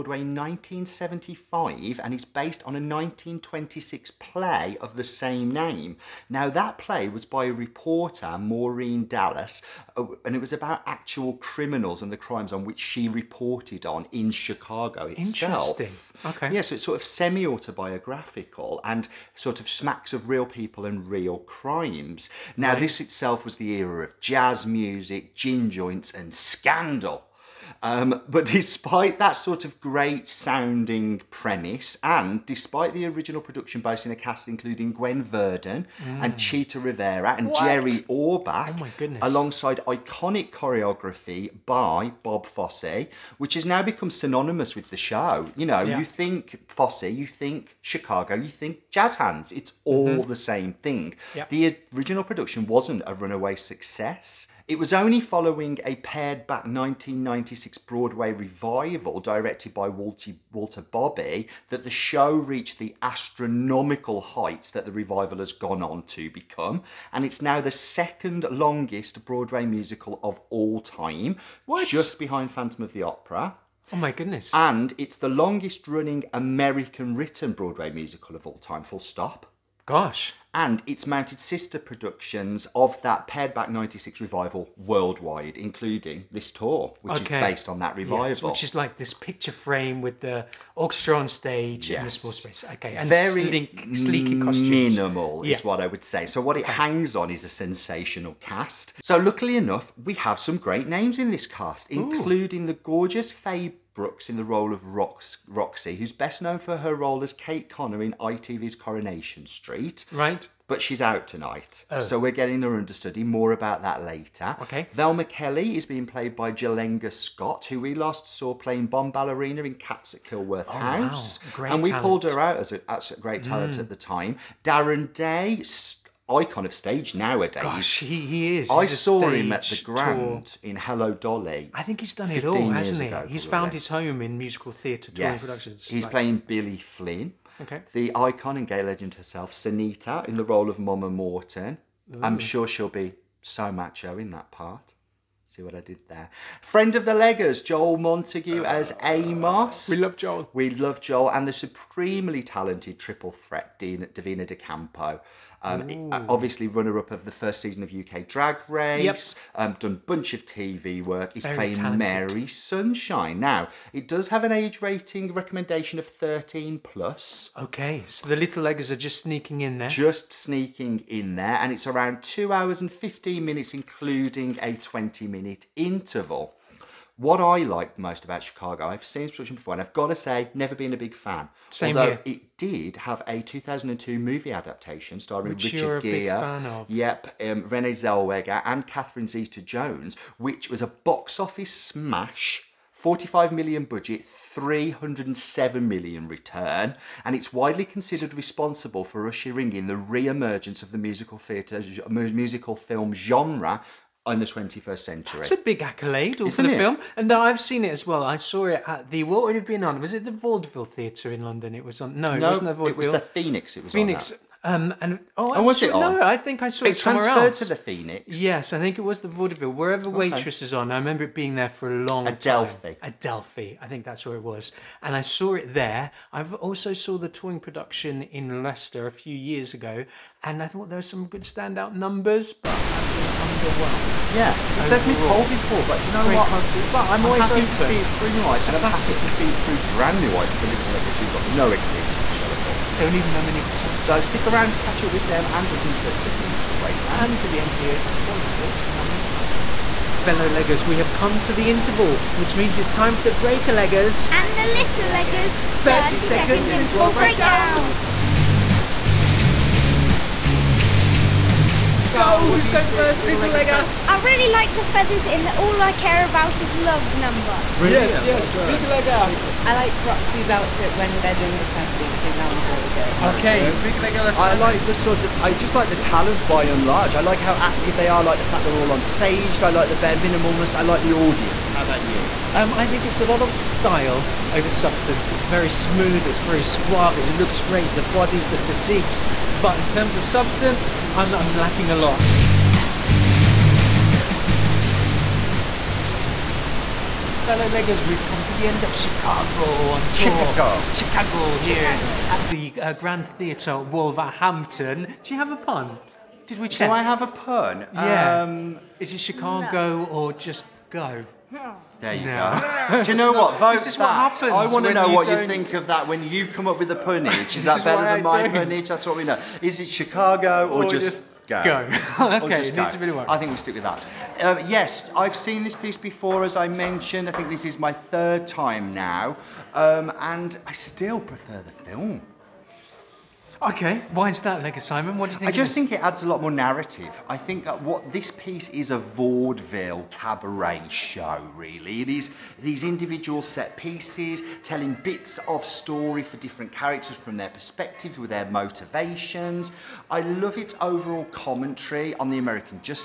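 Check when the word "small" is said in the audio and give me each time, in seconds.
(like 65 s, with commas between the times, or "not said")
92 s.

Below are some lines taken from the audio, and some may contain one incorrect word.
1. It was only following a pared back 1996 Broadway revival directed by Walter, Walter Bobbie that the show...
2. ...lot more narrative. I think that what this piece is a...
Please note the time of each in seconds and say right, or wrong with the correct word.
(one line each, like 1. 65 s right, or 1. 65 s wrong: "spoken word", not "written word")
1. 54 s right
2. 336 s right.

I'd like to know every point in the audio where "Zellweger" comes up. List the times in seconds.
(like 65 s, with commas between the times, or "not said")
187 s.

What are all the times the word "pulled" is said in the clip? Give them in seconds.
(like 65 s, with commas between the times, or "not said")
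122 s.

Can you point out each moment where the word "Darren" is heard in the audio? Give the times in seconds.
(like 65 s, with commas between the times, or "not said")
124 s.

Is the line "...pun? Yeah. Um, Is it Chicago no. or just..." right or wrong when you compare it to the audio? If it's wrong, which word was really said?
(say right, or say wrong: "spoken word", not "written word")
right.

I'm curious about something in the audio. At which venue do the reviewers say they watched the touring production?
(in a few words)
Grand Theatre, Wolverhampton.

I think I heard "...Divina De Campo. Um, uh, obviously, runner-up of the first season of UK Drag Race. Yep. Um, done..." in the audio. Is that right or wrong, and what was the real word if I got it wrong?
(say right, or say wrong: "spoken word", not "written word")
right.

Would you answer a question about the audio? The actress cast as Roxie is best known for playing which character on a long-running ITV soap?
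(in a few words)
Kate Connor.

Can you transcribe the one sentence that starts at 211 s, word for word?
It was on, no, no it wasn't the Vaudeville.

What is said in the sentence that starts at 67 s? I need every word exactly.
And it's now the second longest Broadway musical of all time, what?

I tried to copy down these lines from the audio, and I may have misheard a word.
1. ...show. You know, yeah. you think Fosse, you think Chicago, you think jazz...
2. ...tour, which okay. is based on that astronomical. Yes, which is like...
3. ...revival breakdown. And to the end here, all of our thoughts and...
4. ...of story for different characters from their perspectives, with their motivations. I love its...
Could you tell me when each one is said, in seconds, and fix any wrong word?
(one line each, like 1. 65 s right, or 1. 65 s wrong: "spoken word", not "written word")
1. 44 s right
2. 86 s wrong: "revival", not "astronomical"
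3. 246 s wrong: "interval", not "revival"
4. 345 s right.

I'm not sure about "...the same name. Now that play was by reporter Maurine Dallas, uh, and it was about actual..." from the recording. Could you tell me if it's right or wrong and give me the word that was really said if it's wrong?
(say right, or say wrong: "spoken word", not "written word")
right.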